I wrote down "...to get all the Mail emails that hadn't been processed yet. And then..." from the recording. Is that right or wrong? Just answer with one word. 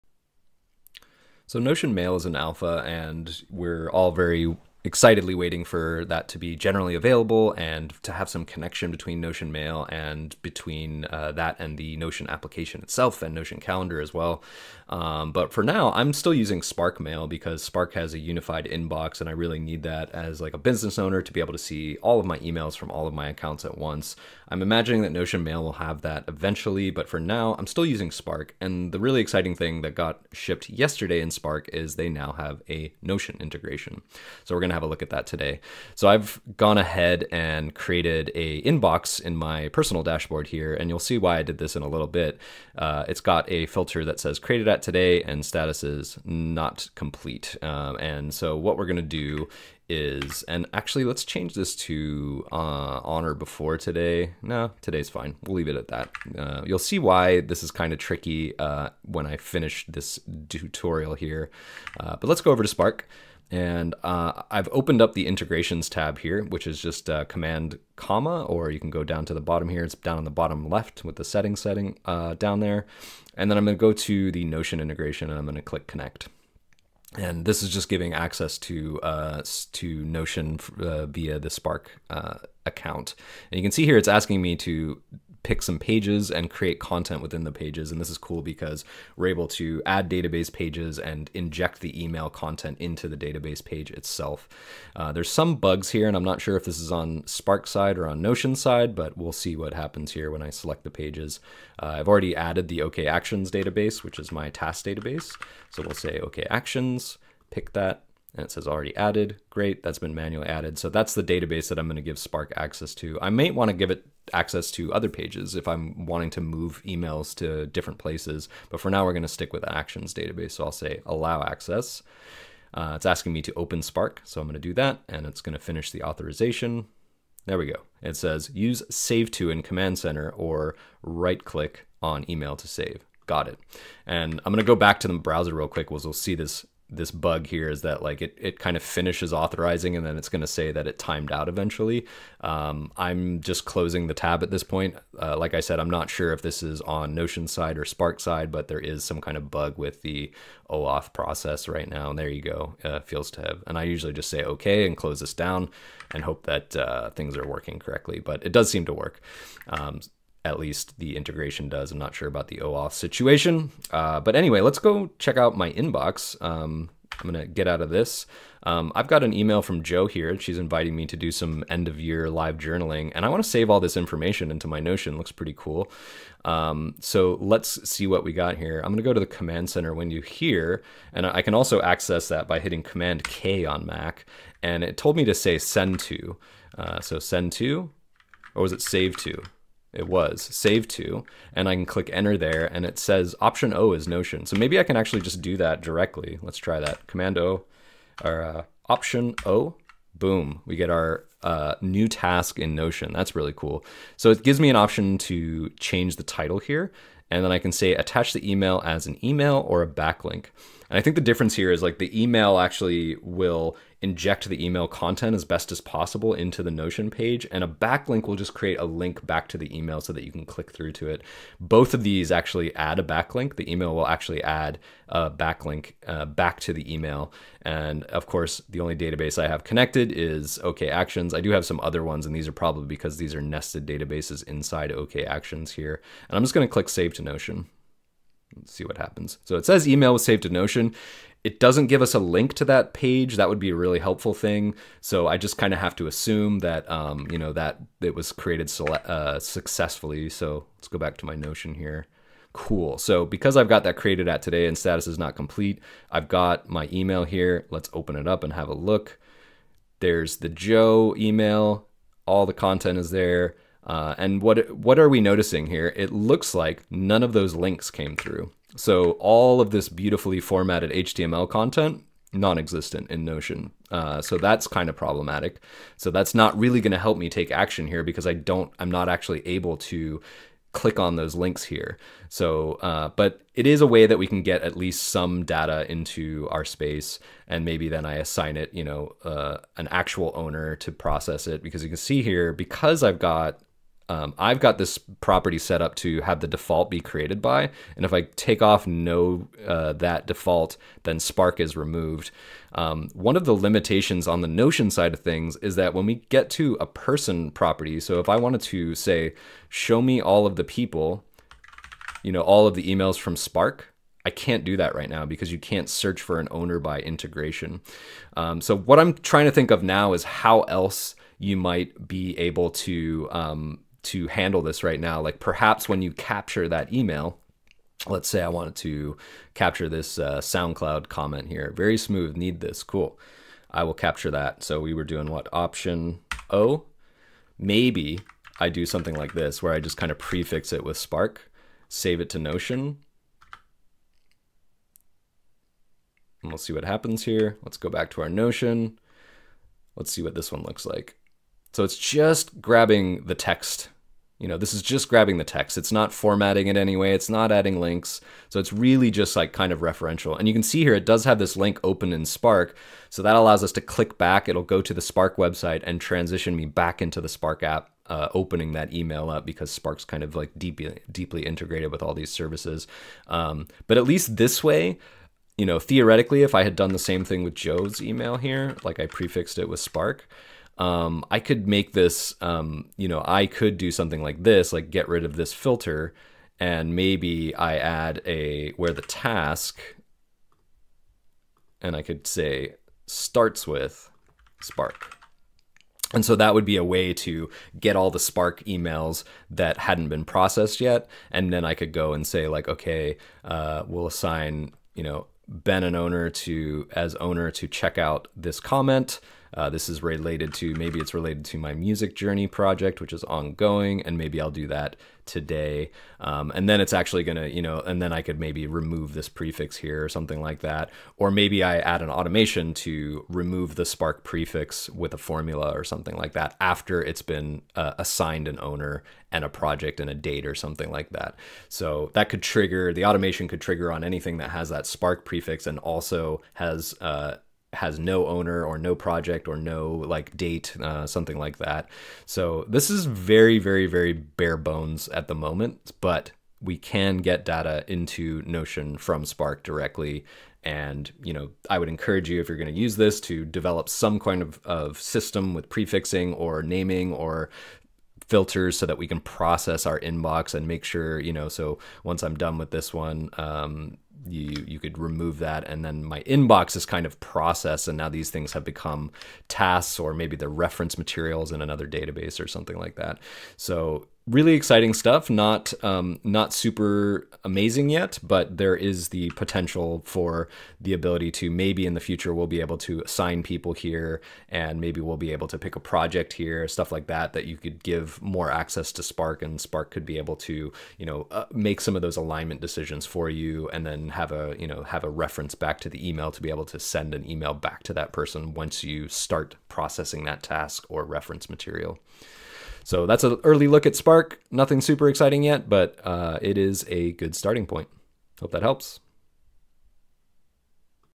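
wrong.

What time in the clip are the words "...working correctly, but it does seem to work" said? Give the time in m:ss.
2:37.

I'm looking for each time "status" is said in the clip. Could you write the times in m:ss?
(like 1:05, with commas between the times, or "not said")
0:45, 4:14.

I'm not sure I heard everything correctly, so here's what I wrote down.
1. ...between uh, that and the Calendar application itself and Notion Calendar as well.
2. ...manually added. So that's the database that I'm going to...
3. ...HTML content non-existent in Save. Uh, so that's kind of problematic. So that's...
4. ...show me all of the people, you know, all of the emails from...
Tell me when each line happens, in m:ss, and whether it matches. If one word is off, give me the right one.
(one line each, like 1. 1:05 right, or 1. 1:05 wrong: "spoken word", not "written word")
1. 0:10 wrong: "Notion", not "Calendar"
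2. 1:50 right
3. 4:30 wrong: "Notion", not "Save"
4. 5:09 right.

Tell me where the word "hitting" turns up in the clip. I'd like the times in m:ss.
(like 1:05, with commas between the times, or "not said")
3:02.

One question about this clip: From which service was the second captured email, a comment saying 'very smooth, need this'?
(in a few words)
SoundCloud.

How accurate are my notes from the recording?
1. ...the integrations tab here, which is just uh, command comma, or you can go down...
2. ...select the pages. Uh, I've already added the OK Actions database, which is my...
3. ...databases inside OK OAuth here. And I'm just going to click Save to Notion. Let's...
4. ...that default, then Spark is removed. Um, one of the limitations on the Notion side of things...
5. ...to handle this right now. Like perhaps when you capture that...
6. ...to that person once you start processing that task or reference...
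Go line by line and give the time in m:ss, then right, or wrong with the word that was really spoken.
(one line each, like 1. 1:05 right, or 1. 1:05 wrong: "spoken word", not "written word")
1. 1:05 right
2. 1:40 right
3. 3:53 wrong: "Actions", not "OAuth"
4. 4:59 right
5. 5:24 right
6. 8:17 right.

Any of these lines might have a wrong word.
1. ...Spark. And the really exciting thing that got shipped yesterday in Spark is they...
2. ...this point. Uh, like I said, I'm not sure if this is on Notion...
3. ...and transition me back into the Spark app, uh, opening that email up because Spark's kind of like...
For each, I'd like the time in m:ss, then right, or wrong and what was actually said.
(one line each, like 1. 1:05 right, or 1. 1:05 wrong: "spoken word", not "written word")
1. 0:28 right
2. 2:24 right
3. 6:05 right.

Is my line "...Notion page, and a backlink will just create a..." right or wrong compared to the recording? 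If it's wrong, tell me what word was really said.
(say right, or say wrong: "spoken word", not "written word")
right.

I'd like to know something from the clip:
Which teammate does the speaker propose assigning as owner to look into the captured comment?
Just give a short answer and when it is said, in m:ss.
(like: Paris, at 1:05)
Ben, at 6:45.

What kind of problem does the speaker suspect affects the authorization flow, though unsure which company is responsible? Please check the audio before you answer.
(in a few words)
OAuth process.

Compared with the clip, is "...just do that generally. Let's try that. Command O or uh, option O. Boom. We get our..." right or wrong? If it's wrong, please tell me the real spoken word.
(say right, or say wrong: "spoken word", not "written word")
wrong: "directly", not "generally".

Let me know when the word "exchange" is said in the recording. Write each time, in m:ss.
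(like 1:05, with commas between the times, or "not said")
not said.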